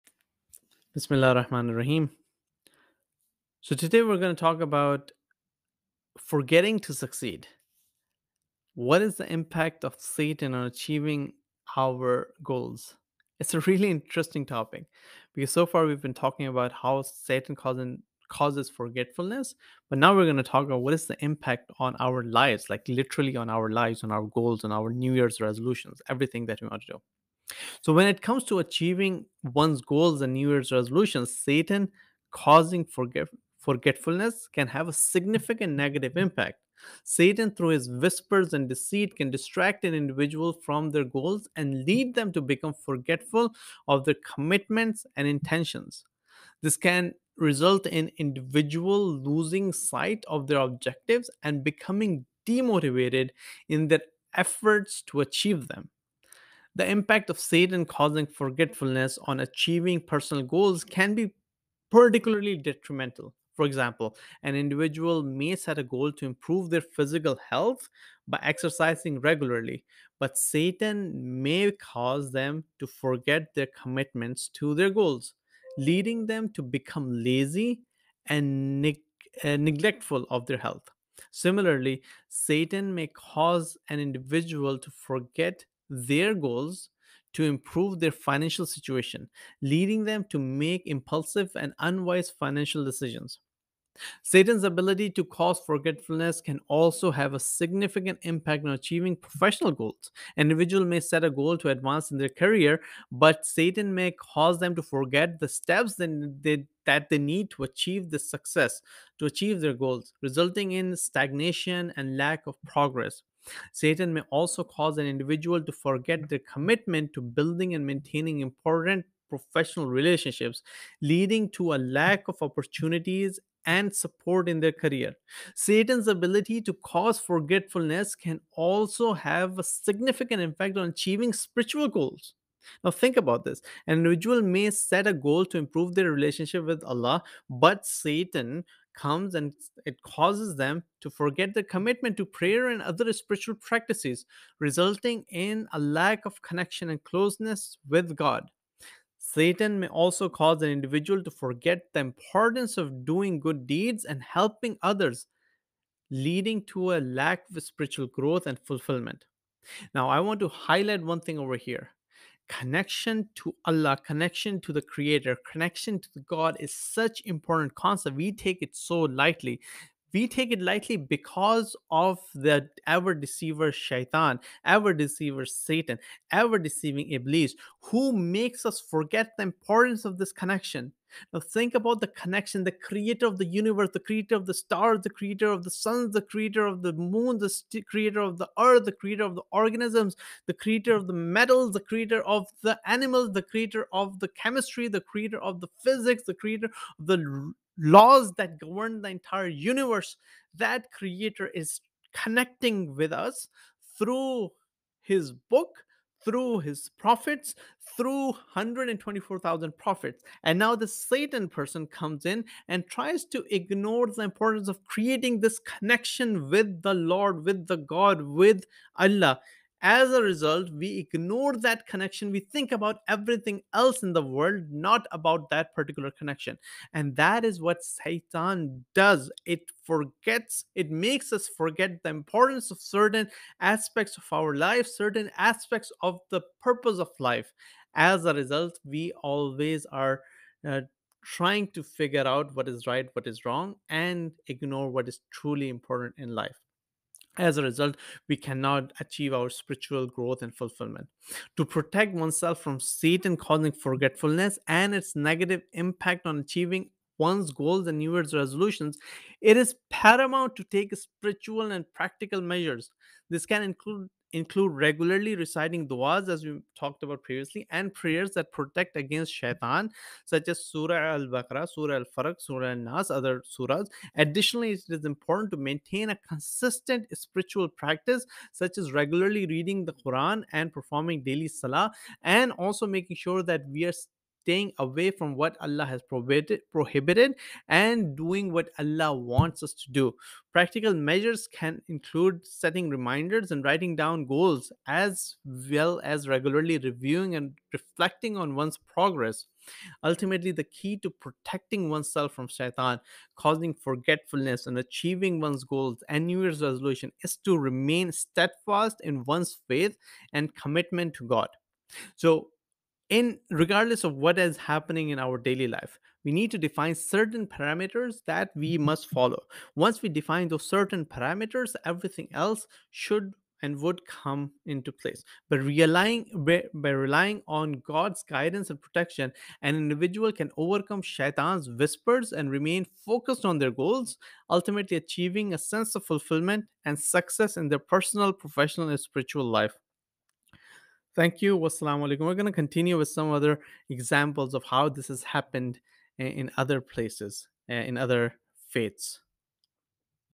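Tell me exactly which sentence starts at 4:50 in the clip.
Practical measures can include setting reminders and writing down goals, as well as regularly reviewing and reflecting on one's progress.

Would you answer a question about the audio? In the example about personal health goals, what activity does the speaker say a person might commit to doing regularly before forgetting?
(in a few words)
exercising.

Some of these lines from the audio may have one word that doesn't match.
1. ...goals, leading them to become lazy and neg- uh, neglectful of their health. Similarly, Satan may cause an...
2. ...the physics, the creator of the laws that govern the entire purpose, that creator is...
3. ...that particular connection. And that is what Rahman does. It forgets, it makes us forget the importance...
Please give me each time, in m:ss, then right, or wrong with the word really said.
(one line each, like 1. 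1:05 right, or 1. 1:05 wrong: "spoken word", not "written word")
1. 1:14 right
2. 3:15 wrong: "universe", not "purpose"
3. 3:45 wrong: "Satan", not "Rahman".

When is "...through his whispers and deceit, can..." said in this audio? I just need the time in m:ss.
0:37.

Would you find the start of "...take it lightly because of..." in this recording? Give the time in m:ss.
2:50.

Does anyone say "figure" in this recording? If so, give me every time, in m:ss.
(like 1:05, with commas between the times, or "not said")
4:01.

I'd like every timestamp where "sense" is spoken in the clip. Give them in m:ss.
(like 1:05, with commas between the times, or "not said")
5:35.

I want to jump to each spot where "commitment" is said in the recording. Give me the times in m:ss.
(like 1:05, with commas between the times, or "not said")
0:44, 1:13, 1:56, 2:21, 5:10.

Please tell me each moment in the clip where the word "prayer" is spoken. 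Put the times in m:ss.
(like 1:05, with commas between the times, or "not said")
2:22, 4:27.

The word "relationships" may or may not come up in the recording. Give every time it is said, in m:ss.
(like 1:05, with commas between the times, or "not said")
1:59, 2:16.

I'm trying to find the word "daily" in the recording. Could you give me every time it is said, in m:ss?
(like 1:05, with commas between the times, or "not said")
4:41, 5:15.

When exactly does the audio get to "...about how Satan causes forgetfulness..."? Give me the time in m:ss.
0:16.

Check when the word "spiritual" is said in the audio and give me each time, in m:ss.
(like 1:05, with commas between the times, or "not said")
2:11, 2:23, 2:37, 4:09, 4:21, 4:37, 5:39.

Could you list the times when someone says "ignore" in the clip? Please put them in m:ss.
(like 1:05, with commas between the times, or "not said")
3:33, 3:40, 4:04.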